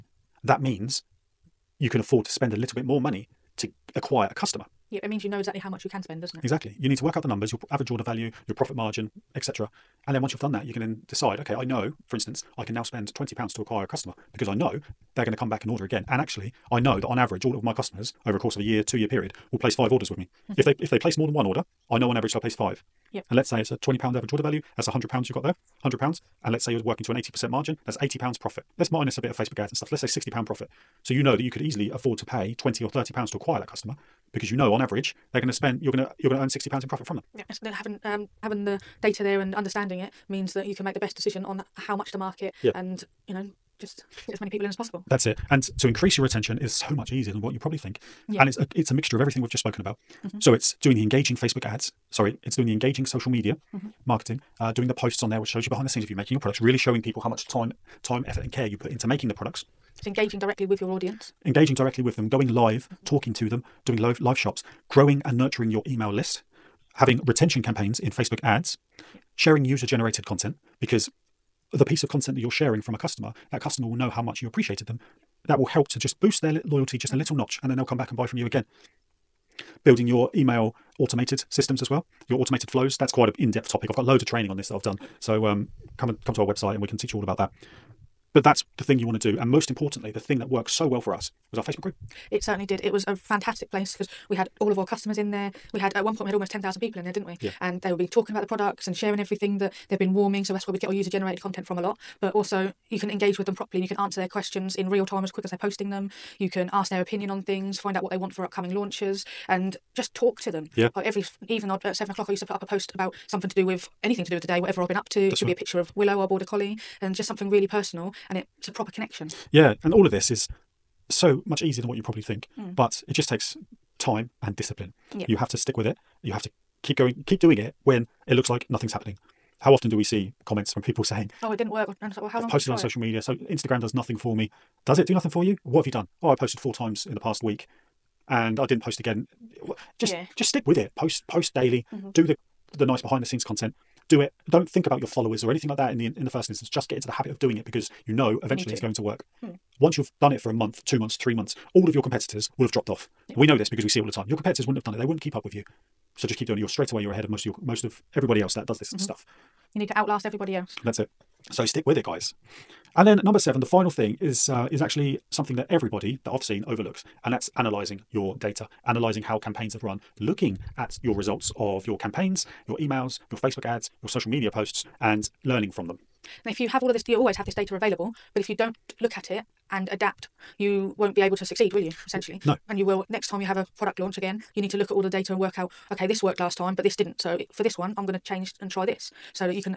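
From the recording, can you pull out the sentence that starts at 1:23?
I've got loads of training on this that I've done.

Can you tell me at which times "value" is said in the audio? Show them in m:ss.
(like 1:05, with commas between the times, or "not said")
0:08, 0:24.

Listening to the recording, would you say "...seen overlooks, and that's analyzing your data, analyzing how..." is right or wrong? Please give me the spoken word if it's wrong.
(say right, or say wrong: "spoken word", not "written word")
right.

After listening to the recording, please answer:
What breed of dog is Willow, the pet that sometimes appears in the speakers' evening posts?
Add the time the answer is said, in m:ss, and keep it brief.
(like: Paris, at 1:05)
border collie, at 1:56.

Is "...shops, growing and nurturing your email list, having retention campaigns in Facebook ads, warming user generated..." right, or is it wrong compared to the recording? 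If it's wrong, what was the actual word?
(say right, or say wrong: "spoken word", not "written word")
wrong: "sharing", not "warming".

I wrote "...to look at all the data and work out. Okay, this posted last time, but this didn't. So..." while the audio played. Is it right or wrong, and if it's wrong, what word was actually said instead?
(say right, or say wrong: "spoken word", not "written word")
wrong: "worked", not "posted".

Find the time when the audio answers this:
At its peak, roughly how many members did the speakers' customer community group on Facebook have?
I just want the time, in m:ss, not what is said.
1:36.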